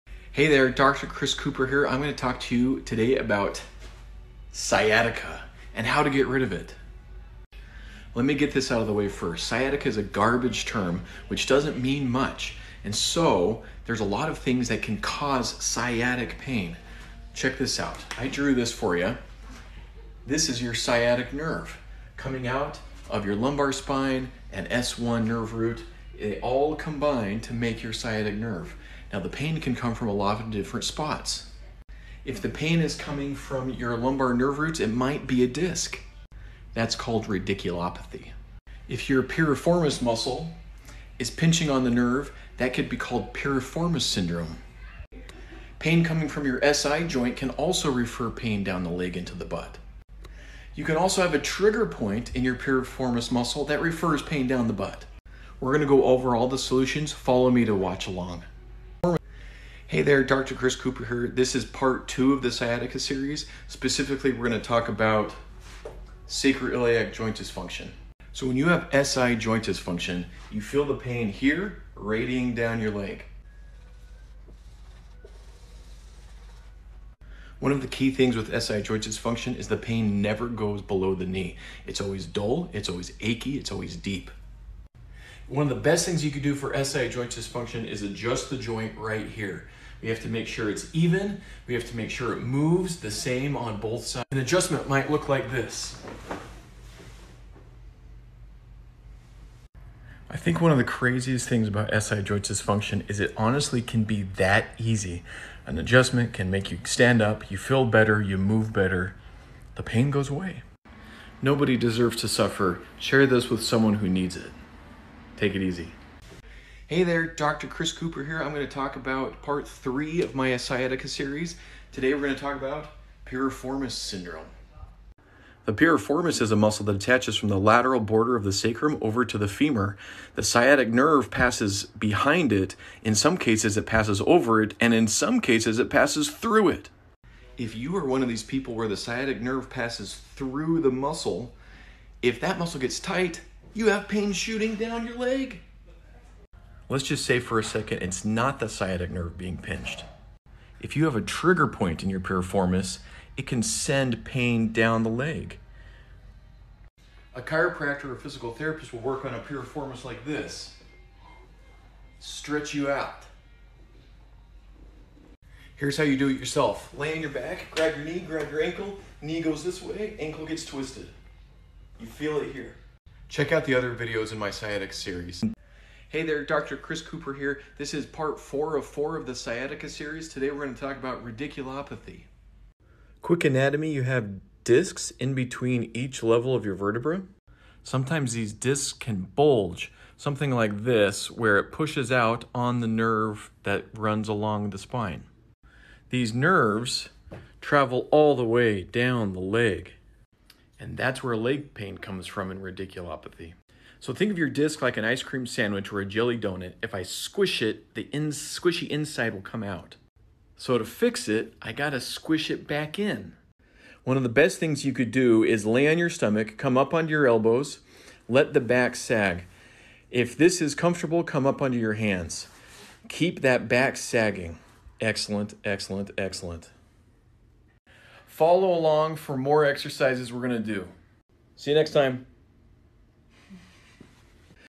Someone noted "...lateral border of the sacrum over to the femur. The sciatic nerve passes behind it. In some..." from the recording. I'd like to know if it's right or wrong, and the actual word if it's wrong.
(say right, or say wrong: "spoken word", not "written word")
right.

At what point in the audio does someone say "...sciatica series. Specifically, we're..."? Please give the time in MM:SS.
01:02.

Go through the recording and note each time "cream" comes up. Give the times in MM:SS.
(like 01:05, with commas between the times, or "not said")
03:25.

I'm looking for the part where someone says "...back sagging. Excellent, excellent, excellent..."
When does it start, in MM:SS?
03:43.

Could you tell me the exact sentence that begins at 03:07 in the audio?
Sometimes these discs can bulge, something like this, where it pushes out on the nerve that runs along the spine.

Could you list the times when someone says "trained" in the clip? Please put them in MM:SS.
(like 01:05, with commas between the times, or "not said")
not said.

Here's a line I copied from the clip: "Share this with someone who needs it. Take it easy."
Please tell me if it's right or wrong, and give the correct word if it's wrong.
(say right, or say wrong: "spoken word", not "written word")
right.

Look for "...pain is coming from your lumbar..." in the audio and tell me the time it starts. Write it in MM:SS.
00:32.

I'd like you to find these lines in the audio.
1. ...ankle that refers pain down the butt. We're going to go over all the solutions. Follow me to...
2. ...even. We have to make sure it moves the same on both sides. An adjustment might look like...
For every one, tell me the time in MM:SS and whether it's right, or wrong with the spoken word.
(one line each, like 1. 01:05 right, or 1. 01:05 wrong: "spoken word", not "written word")
1. 00:53 wrong: "muscle", not "ankle"
2. 01:30 right.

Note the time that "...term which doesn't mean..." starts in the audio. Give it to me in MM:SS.
00:10.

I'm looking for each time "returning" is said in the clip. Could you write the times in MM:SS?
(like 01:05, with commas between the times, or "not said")
not said.